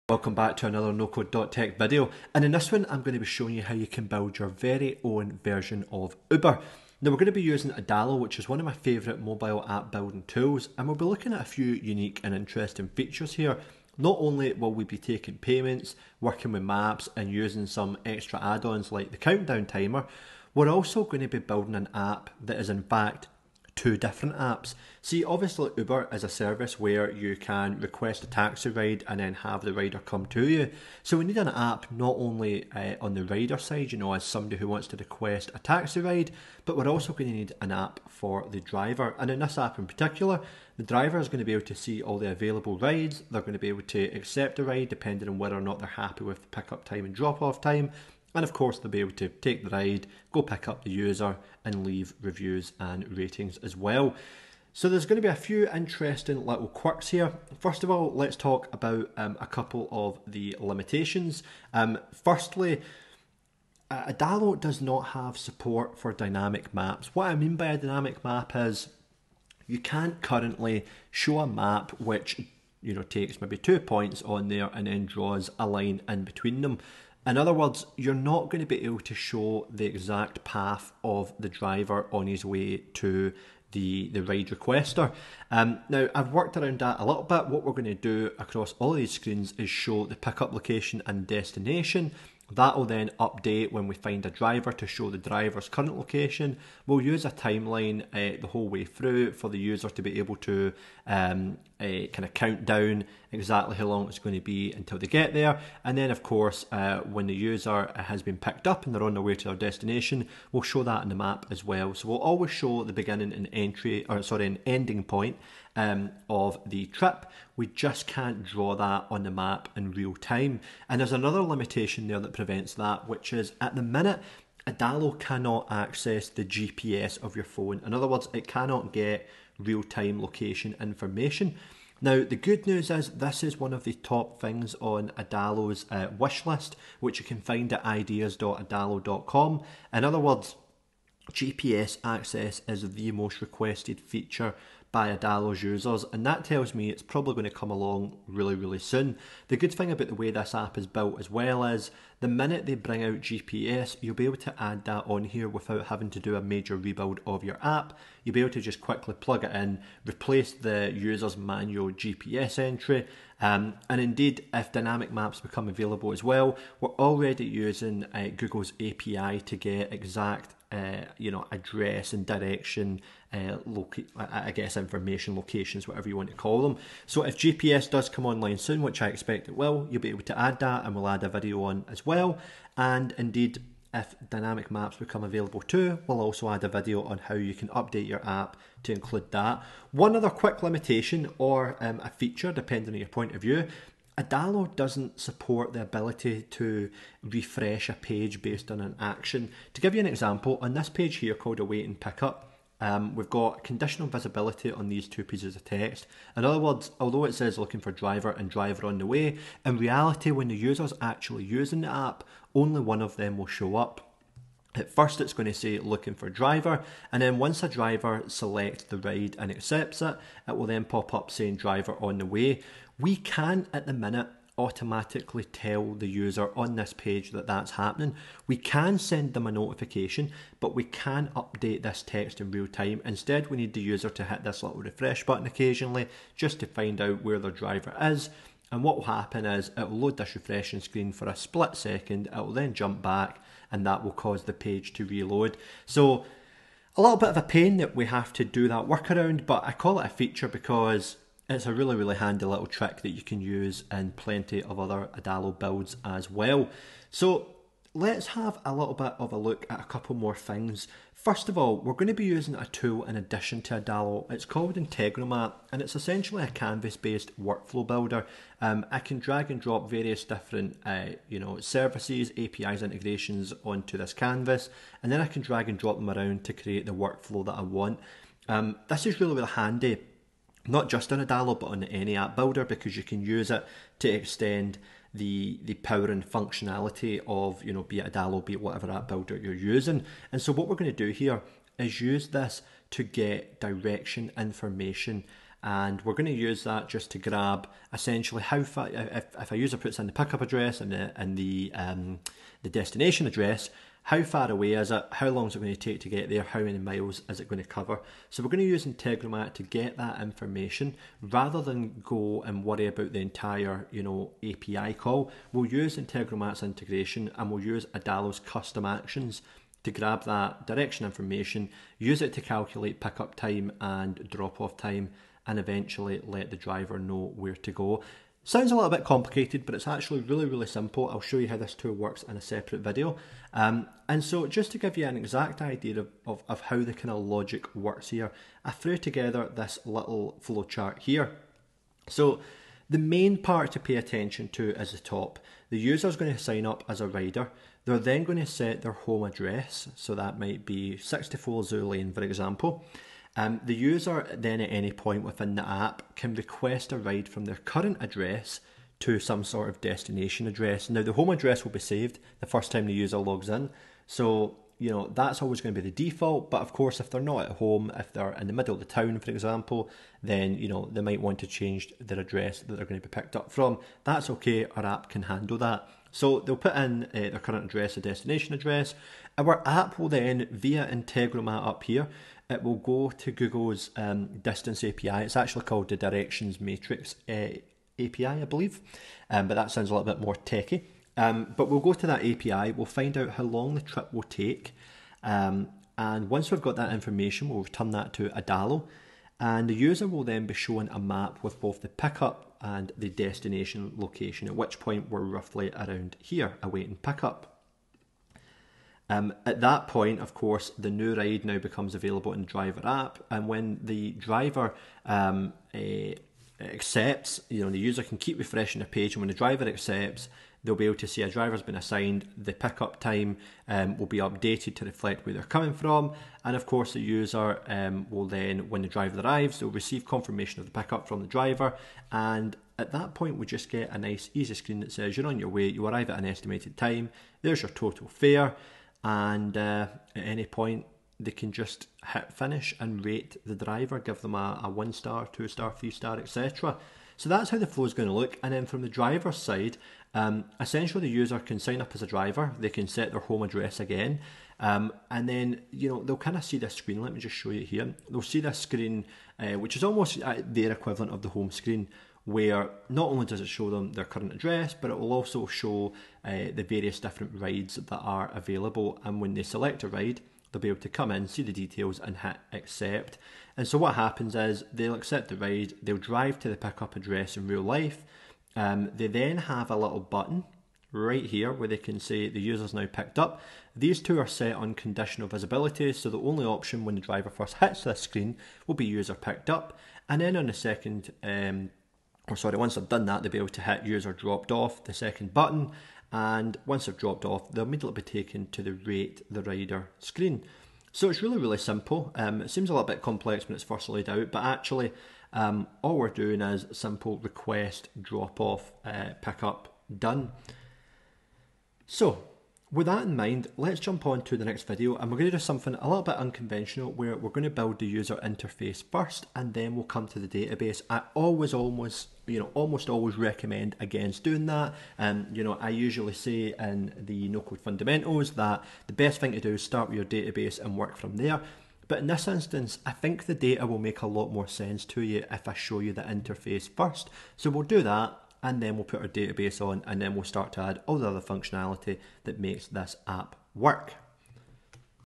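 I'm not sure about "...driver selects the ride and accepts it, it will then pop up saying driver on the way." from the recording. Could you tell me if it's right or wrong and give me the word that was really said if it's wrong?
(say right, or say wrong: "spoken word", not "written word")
right.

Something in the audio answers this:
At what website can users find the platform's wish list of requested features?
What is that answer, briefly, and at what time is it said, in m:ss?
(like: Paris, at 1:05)
ideas.adalo.com, at 2:17.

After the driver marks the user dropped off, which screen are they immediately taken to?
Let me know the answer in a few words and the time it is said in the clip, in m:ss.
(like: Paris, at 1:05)
rate the rider screen, at 8:18.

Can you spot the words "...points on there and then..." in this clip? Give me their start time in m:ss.
1:13.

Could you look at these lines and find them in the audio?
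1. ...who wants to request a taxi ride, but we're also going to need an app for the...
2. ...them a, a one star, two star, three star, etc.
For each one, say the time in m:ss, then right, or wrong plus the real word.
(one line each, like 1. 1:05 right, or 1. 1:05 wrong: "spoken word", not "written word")
1. 0:34 right
2. 7:24 right.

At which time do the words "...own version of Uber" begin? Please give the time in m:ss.
0:05.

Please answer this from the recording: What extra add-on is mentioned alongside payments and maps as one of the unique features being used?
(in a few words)
countdown timer.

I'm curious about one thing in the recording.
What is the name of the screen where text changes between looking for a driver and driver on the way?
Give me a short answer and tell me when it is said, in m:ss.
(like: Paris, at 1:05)
Await and Pickup, at 3:21.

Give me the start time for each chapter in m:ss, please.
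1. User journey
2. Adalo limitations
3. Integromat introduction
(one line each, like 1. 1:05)
1. 5:48
2. 1:09
3. 4:25.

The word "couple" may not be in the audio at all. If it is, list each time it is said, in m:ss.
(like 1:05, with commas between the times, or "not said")
0:59, 4:19.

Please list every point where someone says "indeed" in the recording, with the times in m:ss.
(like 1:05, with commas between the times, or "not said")
2:43, 3:03.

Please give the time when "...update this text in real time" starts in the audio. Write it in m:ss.
3:51.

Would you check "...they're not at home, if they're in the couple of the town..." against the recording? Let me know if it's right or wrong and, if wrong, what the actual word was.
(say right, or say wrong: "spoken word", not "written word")
wrong: "middle", not "couple".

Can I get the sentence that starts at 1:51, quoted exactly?
So we'll always show the beginning and entry, or sorry, an ending point um, of the trip.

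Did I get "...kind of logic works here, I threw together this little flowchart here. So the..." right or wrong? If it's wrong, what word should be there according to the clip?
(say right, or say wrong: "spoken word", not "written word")
right.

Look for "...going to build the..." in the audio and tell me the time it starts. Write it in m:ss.
8:37.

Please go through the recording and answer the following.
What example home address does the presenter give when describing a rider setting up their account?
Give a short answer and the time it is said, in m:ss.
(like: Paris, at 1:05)
64 Zoo Lane, at 5:50.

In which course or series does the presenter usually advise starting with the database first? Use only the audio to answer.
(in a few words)
no code fundamentals.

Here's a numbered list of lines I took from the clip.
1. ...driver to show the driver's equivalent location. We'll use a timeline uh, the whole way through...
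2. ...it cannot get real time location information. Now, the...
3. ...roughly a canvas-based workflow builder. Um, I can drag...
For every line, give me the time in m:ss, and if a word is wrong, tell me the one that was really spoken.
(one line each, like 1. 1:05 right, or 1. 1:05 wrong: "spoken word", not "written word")
1. 1:34 wrong: "current", not "equivalent"
2. 2:08 right
3. 4:25 wrong: "essentially", not "roughly".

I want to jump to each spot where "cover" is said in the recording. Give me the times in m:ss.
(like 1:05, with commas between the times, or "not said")
5:07.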